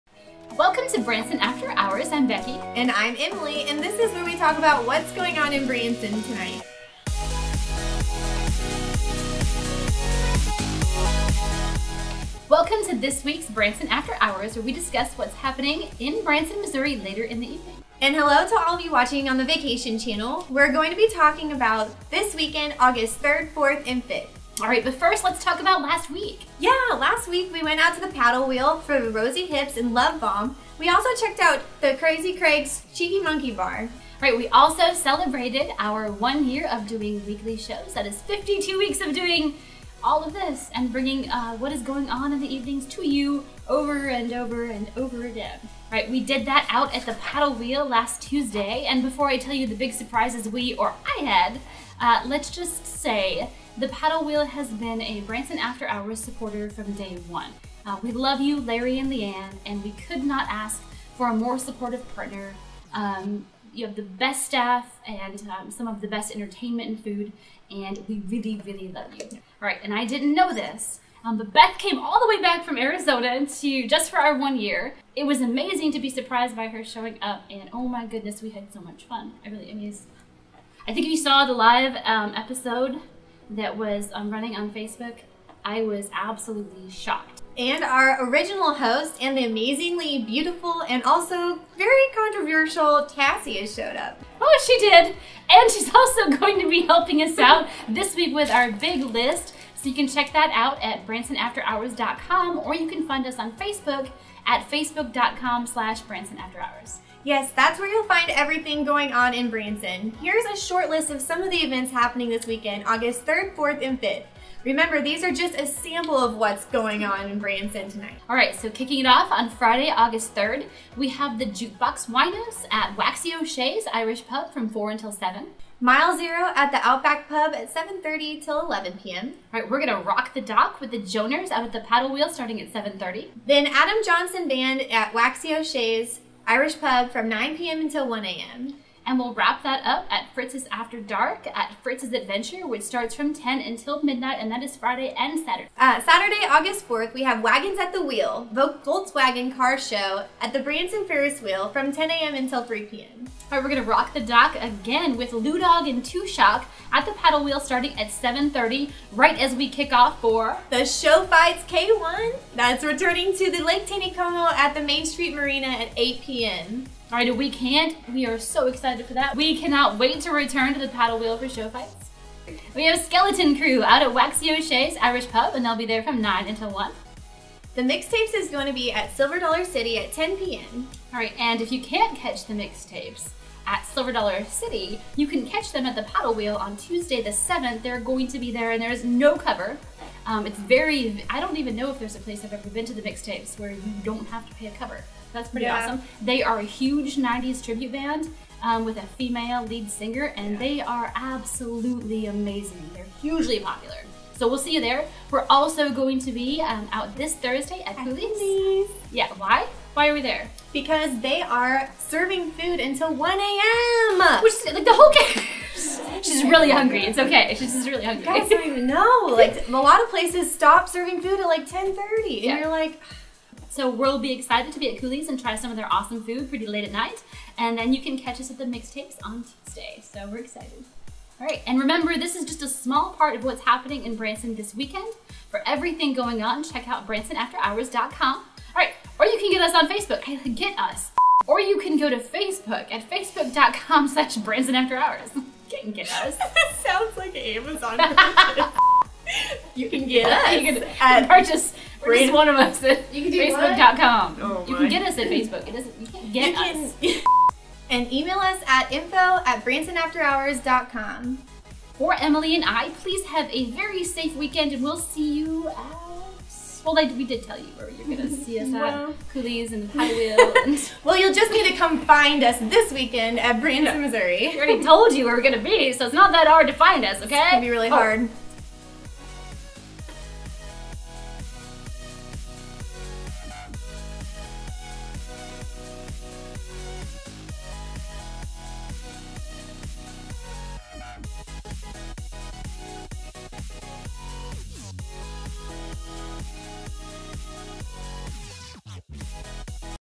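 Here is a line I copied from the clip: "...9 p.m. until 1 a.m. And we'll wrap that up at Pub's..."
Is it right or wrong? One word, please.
wrong.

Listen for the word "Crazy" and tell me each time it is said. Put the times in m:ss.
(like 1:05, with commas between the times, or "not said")
0:31.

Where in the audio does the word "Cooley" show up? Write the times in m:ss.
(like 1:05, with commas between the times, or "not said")
3:28, 3:44, 4:29.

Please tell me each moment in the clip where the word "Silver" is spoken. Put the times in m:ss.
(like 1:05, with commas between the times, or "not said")
2:59, 3:03.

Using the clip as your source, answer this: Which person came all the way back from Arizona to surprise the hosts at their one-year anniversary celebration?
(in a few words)
Beth.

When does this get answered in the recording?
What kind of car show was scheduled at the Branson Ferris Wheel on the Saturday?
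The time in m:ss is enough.
2:28.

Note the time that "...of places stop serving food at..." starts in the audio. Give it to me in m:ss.
3:40.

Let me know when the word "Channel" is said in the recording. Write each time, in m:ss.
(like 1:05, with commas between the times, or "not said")
0:19.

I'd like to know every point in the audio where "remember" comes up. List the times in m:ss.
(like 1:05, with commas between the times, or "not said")
1:54, 3:51.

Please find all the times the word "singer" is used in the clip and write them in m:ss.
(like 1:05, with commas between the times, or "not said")
3:19.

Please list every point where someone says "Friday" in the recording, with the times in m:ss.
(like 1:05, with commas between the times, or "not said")
1:59, 2:24.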